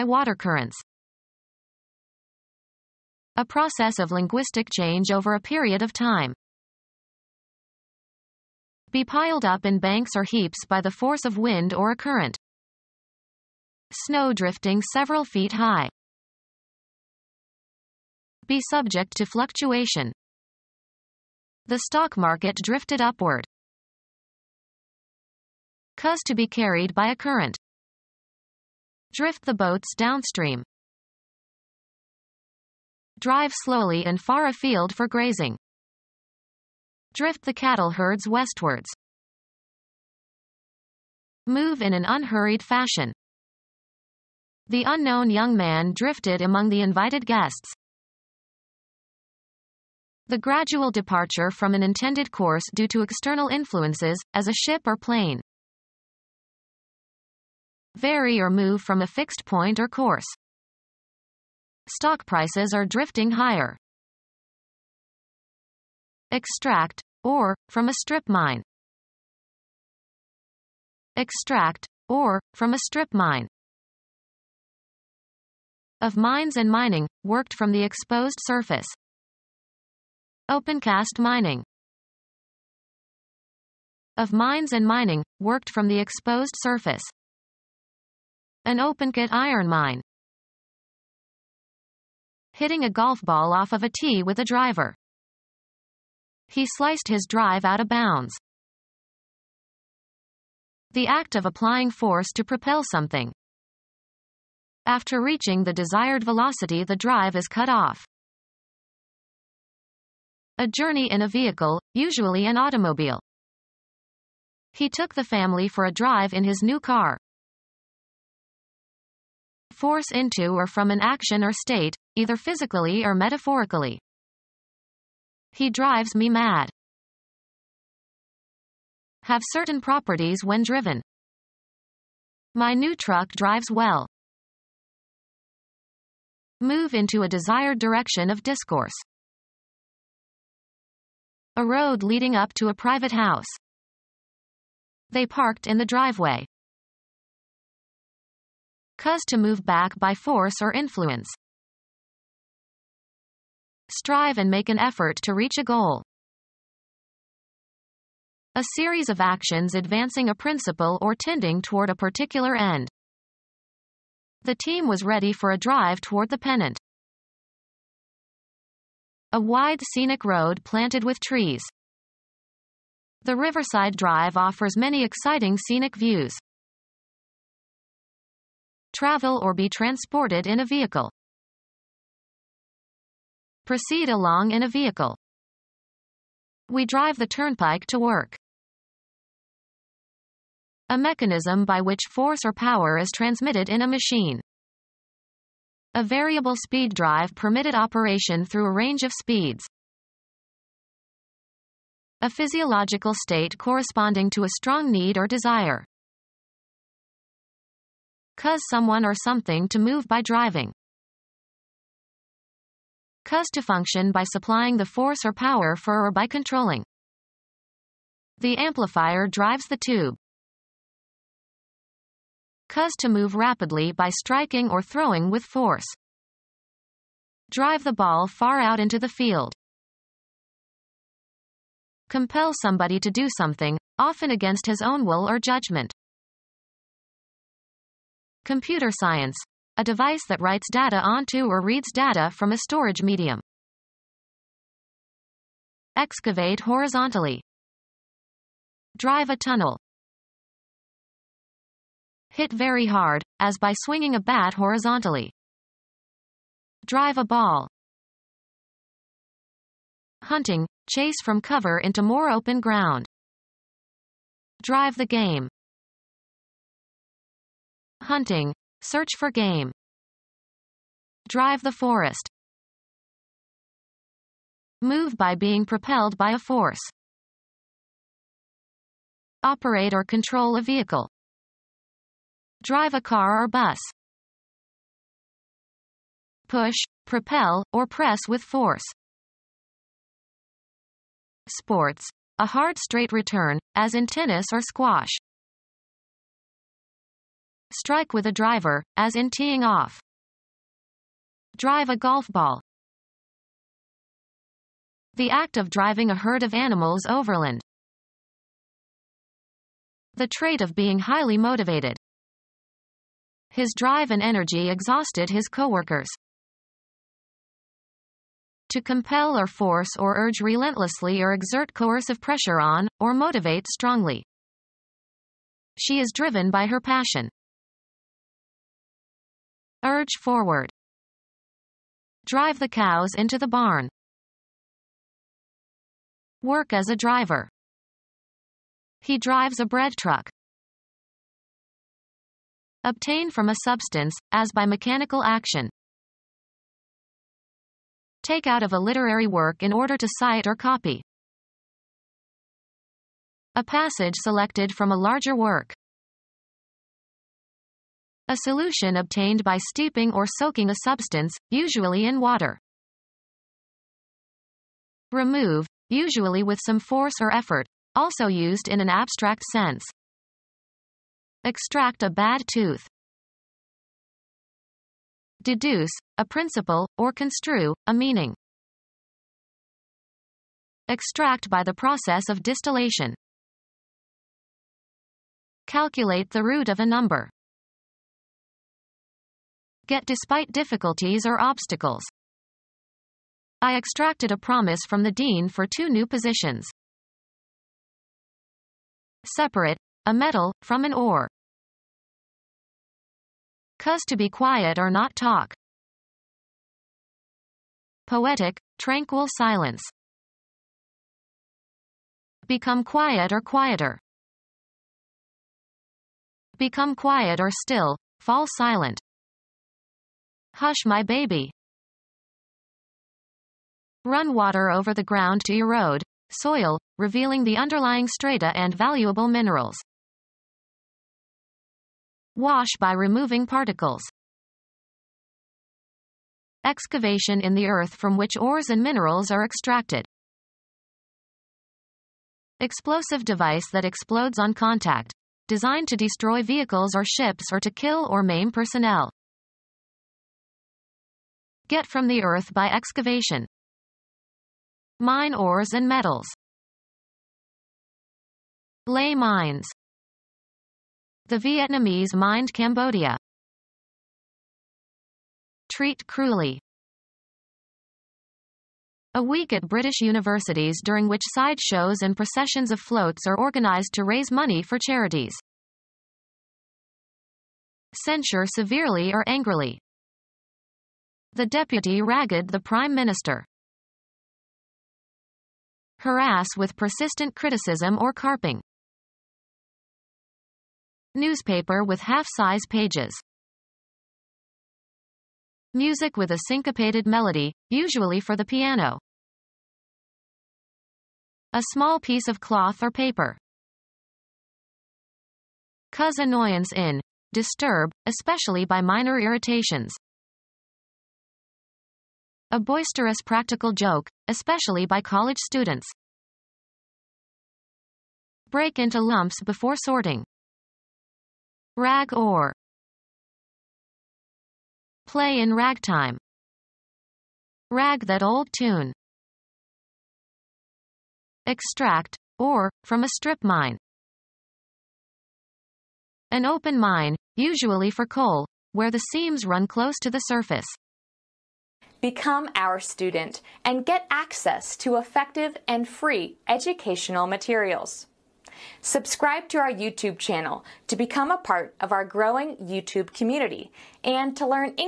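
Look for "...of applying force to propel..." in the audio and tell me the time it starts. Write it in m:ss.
1:41.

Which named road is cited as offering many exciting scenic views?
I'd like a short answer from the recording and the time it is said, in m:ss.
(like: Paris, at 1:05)
Riverside Drive, at 2:53.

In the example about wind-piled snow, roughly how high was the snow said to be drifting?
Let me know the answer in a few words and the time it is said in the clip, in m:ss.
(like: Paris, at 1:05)
several feet, at 0:14.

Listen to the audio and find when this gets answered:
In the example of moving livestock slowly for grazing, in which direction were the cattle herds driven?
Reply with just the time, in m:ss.
0:38.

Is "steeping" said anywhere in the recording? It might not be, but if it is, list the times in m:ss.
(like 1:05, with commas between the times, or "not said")
5:59.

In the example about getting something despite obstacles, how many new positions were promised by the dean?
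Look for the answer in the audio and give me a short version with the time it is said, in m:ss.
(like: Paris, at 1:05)
2, at 6:35.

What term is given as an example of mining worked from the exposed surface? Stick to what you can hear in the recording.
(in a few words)
Opencast mining.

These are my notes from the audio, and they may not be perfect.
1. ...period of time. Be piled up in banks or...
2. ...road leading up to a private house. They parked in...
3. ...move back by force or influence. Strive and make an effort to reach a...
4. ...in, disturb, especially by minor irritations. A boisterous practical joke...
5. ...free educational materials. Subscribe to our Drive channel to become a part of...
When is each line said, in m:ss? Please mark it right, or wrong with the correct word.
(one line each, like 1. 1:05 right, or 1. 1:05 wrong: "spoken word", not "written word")
1. 0:05 right
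2. 2:21 right
3. 2:29 right
4. 8:26 right
5. 9:05 wrong: "YouTube", not "Drive".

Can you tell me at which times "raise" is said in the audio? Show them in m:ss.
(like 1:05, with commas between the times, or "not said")
7:54.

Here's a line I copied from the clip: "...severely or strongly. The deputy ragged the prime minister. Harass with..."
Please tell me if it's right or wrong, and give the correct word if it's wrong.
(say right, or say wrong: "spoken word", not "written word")
wrong: "angrily", not "strongly".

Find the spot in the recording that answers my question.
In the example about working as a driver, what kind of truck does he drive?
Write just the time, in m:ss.
5:39.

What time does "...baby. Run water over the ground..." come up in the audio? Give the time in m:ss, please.
7:01.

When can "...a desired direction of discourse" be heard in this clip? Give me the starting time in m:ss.
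2:17.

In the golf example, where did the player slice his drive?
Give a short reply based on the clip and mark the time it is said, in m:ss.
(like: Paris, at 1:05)
out of bounds, at 1:37.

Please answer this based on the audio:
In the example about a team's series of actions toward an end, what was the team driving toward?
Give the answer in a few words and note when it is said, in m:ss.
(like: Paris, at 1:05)
the pennant, at 2:46.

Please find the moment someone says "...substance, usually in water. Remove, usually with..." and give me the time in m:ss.
6:00.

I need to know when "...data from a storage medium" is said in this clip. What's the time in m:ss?
4:01.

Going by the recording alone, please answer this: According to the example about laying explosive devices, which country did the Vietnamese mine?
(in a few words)
Cambodia.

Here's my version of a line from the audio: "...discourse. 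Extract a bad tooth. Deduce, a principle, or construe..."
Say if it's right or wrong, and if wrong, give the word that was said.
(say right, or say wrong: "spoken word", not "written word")
wrong: "sense", not "discourse".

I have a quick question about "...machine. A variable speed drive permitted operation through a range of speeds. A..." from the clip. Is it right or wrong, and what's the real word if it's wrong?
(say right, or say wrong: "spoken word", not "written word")
right.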